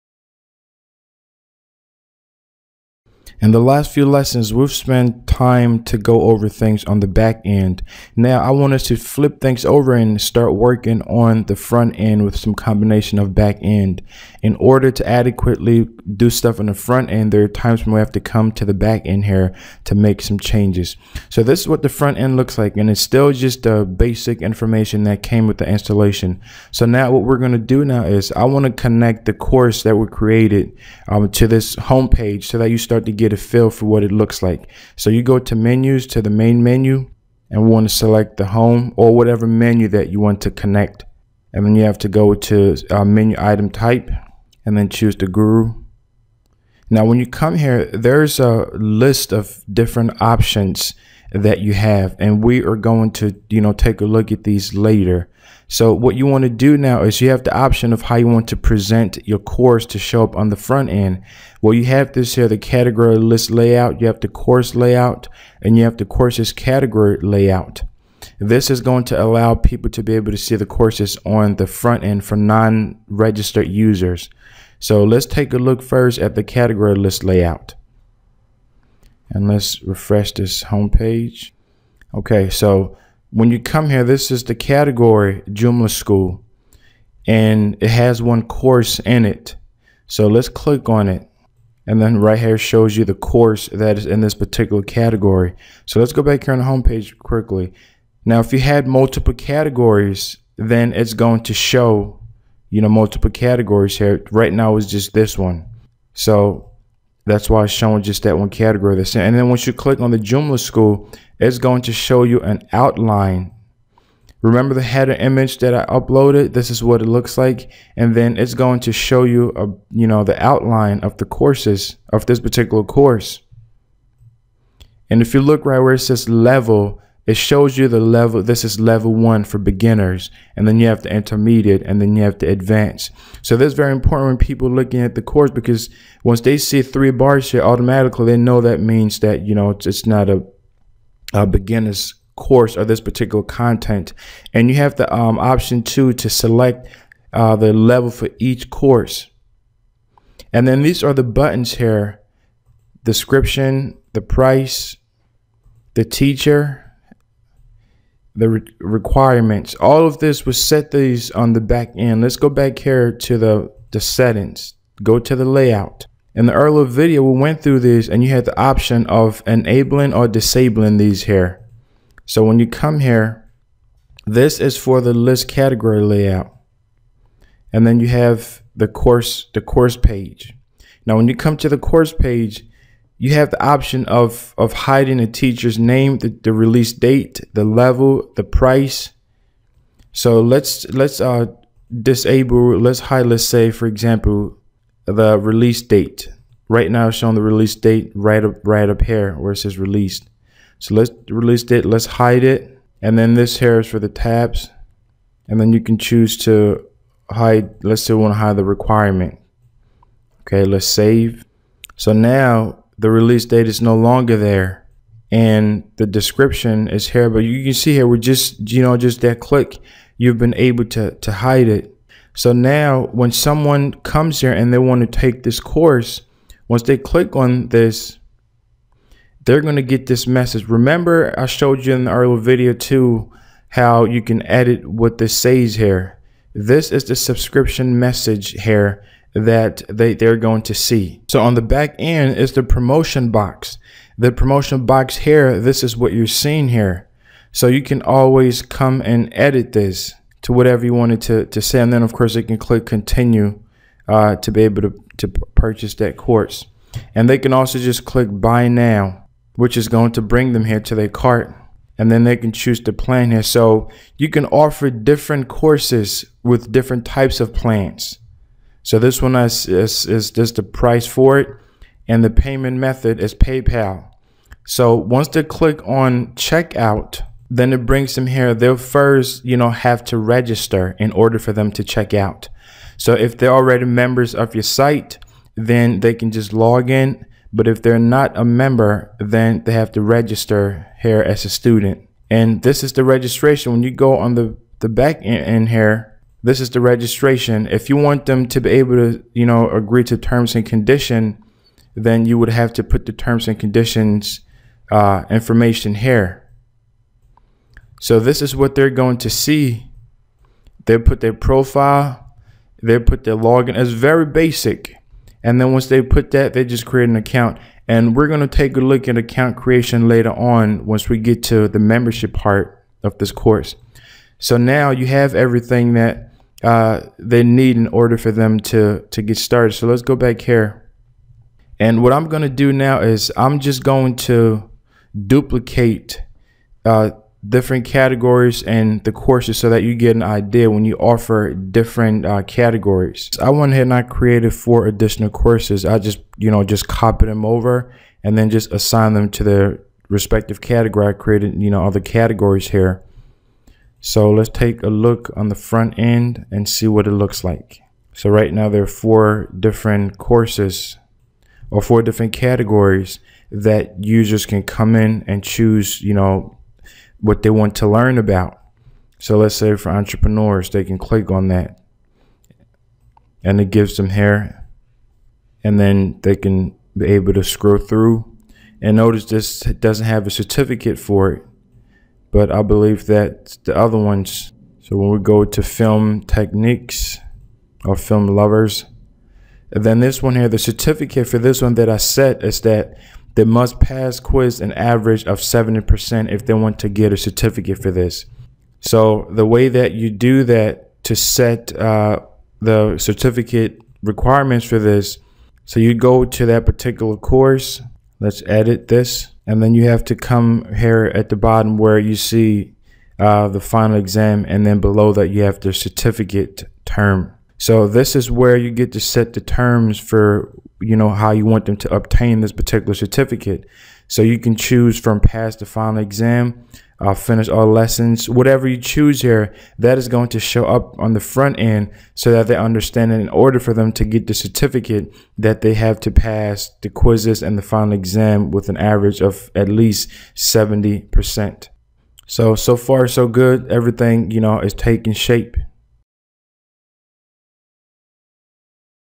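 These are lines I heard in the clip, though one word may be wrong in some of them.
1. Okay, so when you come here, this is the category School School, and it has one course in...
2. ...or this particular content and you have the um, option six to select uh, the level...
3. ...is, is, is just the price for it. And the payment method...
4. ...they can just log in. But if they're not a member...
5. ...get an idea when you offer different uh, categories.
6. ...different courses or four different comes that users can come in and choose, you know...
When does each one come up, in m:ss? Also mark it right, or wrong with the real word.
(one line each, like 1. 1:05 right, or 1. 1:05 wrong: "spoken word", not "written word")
1. 1:22 wrong: "Joomla", not "School"
2. 2:22 wrong: "two", not "six"
3. 4:29 right
4. 4:45 right
5. 5:39 right
6. 5:59 wrong: "categories", not "comes".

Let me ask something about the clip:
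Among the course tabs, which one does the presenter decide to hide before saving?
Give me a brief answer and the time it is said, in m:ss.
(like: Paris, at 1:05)
Requirement, at 3:28.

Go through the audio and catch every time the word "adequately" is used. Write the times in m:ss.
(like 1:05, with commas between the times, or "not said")
0:15.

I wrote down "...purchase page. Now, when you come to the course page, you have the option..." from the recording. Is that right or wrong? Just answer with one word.
wrong.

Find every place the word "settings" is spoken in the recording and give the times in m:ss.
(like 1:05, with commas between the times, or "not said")
2:43.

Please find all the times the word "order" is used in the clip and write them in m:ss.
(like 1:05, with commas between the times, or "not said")
0:14, 4:41, 5:27, 7:13.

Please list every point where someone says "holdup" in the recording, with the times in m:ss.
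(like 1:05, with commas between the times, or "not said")
not said.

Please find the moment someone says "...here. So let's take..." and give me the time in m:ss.
5:52.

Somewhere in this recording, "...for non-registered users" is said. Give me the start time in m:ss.
1:12.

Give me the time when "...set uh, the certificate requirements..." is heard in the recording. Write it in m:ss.
6:41.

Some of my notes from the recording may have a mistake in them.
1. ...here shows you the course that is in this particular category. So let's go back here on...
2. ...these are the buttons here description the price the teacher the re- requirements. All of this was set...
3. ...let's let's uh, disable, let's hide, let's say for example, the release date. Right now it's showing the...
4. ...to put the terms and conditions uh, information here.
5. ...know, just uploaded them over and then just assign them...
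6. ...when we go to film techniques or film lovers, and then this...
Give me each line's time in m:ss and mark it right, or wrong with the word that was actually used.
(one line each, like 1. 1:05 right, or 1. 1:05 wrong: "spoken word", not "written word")
1. 1:32 right
2. 2:30 right
3. 3:10 right
4. 5:02 right
5. 5:46 wrong: "copied", not "uploaded"
6. 6:24 right.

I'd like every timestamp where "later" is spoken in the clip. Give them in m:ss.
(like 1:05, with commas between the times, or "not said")
0:54, 5:20.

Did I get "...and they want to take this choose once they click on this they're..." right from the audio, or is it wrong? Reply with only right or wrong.
wrong.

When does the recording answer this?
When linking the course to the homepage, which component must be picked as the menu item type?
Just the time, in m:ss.
0:45.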